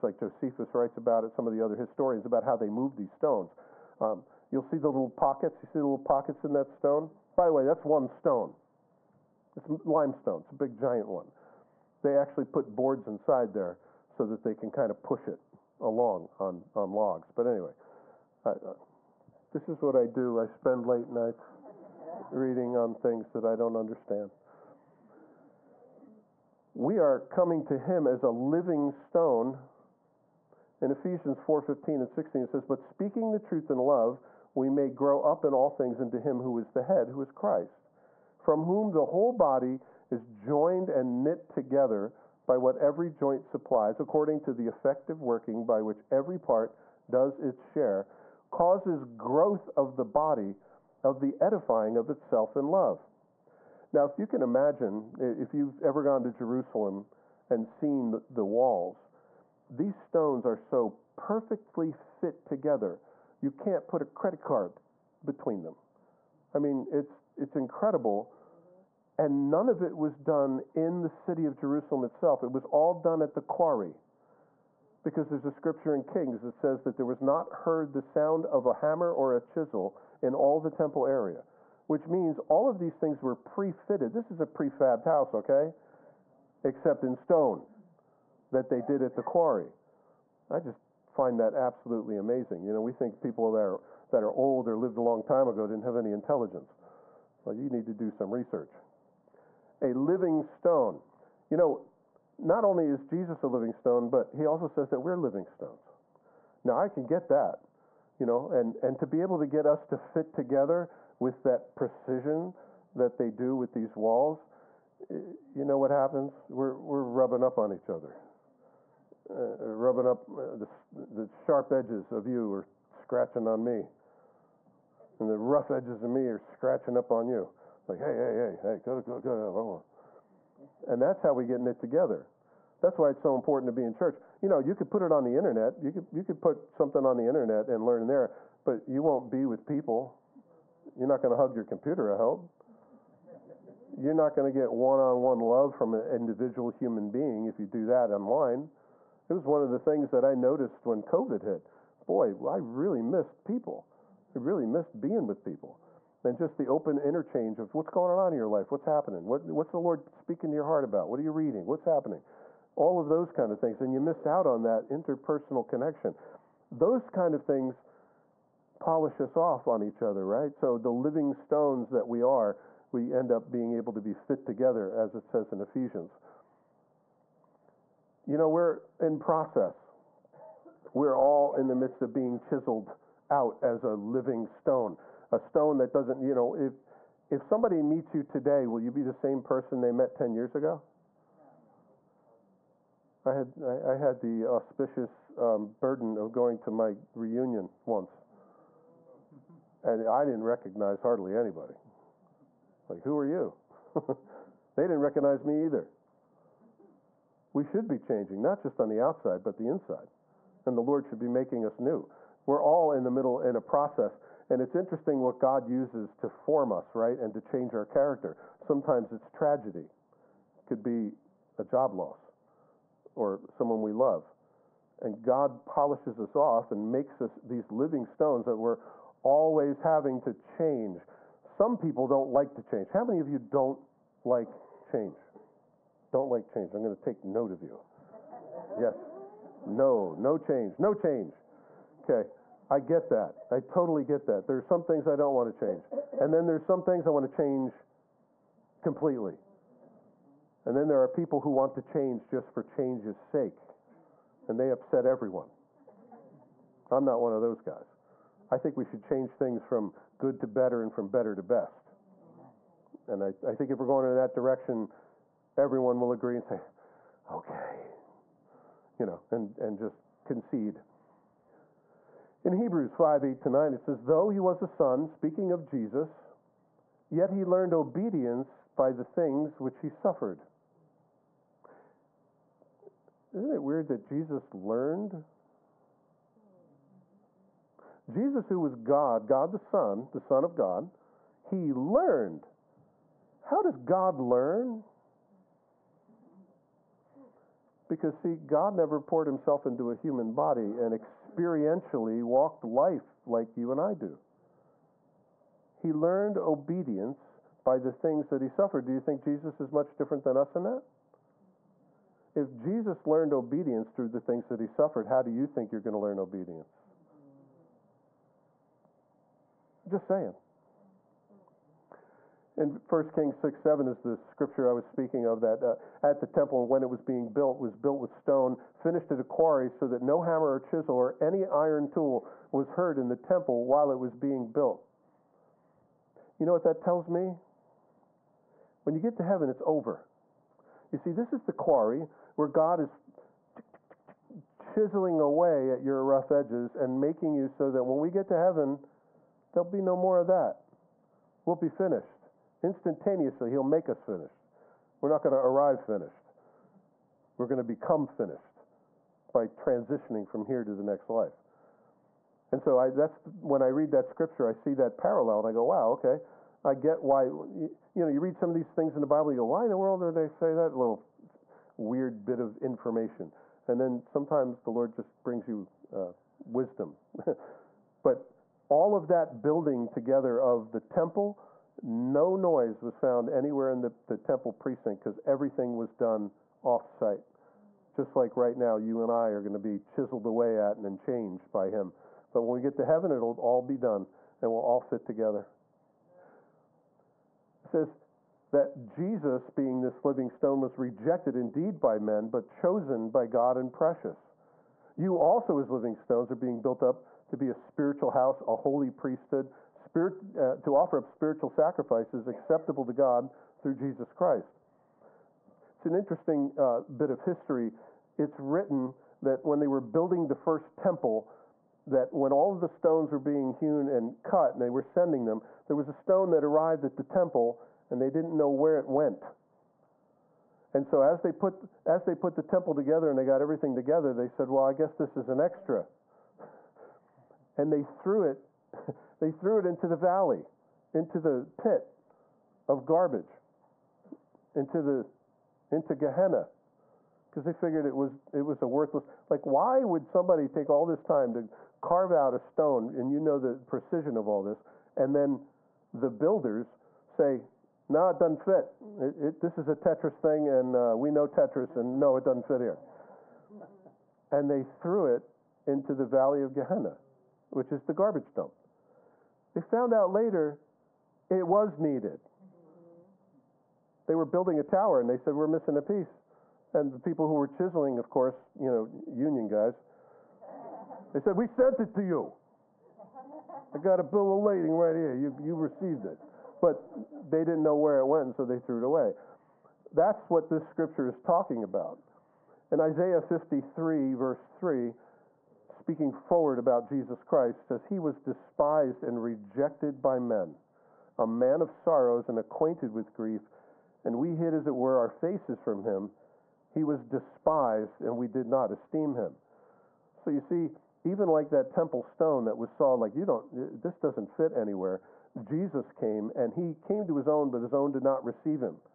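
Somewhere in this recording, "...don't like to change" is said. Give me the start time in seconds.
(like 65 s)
232 s.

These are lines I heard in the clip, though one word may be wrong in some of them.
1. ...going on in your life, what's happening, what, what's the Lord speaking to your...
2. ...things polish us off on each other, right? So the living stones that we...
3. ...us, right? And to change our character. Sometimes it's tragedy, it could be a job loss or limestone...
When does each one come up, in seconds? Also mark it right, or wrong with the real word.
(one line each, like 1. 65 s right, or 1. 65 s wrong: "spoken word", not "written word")
1. 157 s right
2. 167 s right
3. 216 s wrong: "someone", not "limestone".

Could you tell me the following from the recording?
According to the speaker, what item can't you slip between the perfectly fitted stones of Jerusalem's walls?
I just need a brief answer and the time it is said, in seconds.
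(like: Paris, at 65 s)
A credit card, at 64 s.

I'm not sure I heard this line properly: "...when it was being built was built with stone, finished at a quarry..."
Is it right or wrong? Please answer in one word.
right.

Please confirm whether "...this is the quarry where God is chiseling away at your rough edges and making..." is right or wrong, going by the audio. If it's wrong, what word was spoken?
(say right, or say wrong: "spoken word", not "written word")
right.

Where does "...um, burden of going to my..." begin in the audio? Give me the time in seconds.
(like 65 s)
195 s.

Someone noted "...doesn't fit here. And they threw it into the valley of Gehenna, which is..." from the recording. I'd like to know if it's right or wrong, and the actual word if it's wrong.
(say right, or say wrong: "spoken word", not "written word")
right.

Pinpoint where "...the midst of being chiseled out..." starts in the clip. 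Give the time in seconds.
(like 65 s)
181 s.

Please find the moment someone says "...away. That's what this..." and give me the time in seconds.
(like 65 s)
488 s.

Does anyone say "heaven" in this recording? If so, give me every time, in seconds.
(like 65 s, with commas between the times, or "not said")
339 s, 348 s, 392 s.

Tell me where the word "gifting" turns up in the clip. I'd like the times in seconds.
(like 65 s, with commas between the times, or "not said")
not said.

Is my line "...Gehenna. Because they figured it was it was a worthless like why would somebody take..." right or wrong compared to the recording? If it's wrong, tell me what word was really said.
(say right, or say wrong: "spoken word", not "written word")
right.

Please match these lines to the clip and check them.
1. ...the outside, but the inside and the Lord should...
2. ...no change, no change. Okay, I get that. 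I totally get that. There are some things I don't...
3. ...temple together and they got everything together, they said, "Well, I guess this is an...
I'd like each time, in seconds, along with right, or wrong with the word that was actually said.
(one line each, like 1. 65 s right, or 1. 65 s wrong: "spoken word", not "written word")
1. 208 s right
2. 240 s right
3. 432 s right.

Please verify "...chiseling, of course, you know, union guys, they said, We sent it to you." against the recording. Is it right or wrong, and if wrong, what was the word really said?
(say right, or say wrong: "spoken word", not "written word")
right.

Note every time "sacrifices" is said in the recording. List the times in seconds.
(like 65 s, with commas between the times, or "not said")
411 s.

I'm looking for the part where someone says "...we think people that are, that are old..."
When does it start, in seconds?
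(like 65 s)
92 s.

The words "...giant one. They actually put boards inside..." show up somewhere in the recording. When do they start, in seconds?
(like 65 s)
10 s.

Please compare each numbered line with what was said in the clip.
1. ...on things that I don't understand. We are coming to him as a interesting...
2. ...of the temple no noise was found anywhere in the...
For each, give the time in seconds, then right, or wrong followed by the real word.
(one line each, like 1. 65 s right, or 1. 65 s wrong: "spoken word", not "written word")
1. 22 s wrong: "living", not "interesting"
2. 380 s right.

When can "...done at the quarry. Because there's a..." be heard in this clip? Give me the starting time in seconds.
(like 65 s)
72 s.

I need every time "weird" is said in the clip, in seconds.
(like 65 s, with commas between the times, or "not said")
283 s, 371 s.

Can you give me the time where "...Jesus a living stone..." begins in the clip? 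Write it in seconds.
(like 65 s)
103 s.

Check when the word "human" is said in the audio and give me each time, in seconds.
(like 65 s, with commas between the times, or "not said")
146 s, 299 s.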